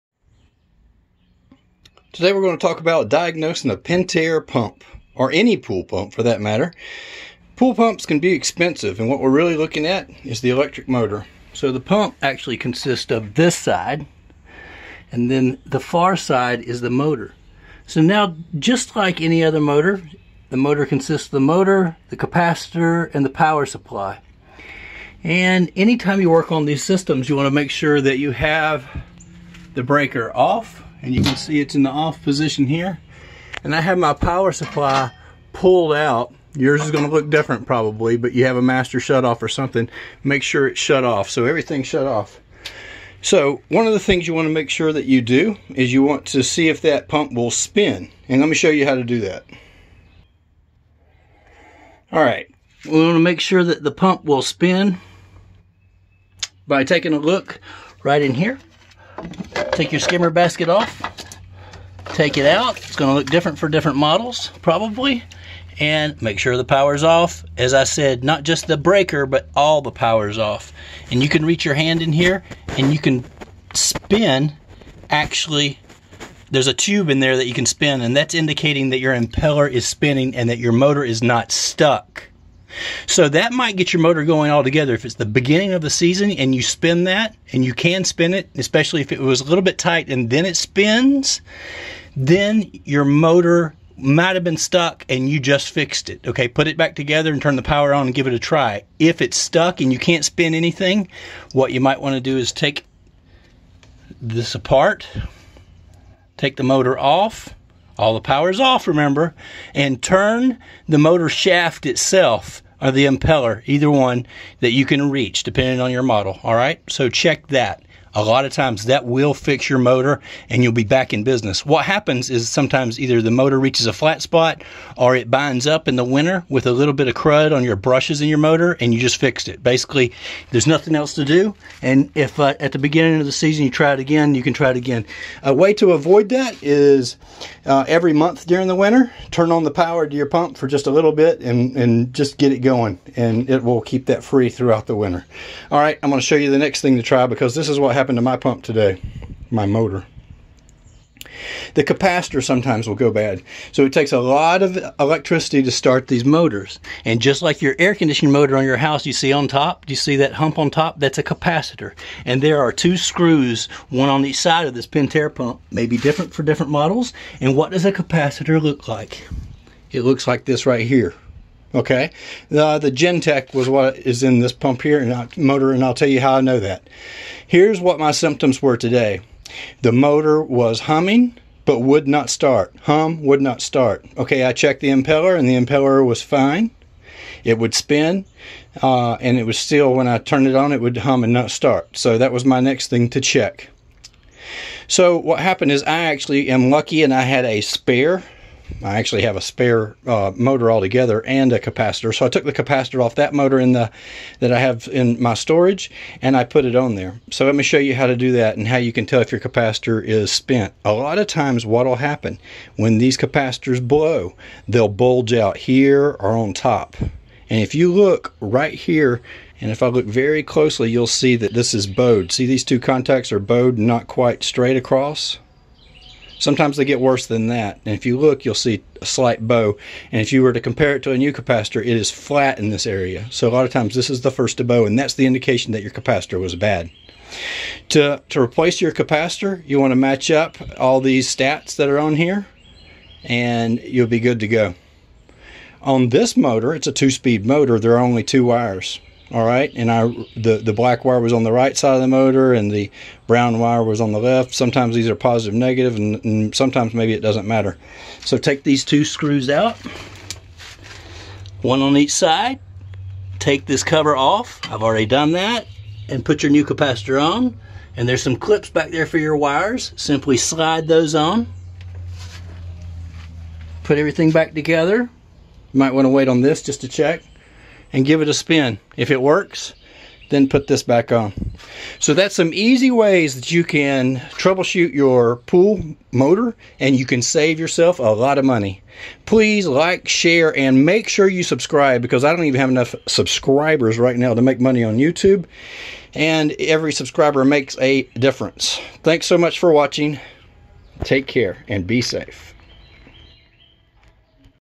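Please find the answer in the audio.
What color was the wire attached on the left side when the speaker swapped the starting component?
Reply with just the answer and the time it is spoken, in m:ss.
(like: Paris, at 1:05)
Brown, at 4:13.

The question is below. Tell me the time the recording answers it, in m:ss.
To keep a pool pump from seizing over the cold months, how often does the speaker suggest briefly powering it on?
2:17.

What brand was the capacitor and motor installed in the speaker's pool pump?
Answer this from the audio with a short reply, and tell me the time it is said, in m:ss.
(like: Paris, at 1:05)
Genteq, at 2:52.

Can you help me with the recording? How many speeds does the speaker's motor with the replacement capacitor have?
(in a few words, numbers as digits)
2.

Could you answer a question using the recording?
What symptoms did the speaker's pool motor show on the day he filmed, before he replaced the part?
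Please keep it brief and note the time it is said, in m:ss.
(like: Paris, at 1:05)
Humming but would not start, at 3:00.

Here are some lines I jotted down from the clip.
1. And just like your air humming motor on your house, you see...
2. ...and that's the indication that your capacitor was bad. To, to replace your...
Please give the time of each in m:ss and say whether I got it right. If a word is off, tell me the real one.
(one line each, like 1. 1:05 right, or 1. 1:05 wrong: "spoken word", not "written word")
1. 2:37 wrong: "conditioning", not "humming"
2. 3:54 right.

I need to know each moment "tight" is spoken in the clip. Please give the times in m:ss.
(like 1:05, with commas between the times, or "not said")
1:29.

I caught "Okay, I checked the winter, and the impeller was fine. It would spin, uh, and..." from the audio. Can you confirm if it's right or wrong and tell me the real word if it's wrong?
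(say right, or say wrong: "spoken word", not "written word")
wrong: "impeller", not "winter".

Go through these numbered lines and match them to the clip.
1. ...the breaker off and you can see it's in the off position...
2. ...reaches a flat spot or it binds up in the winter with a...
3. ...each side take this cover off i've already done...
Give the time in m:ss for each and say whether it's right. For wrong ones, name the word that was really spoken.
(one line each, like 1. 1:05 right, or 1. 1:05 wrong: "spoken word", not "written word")
1. 0:29 right
2. 2:03 right
3. 4:21 right.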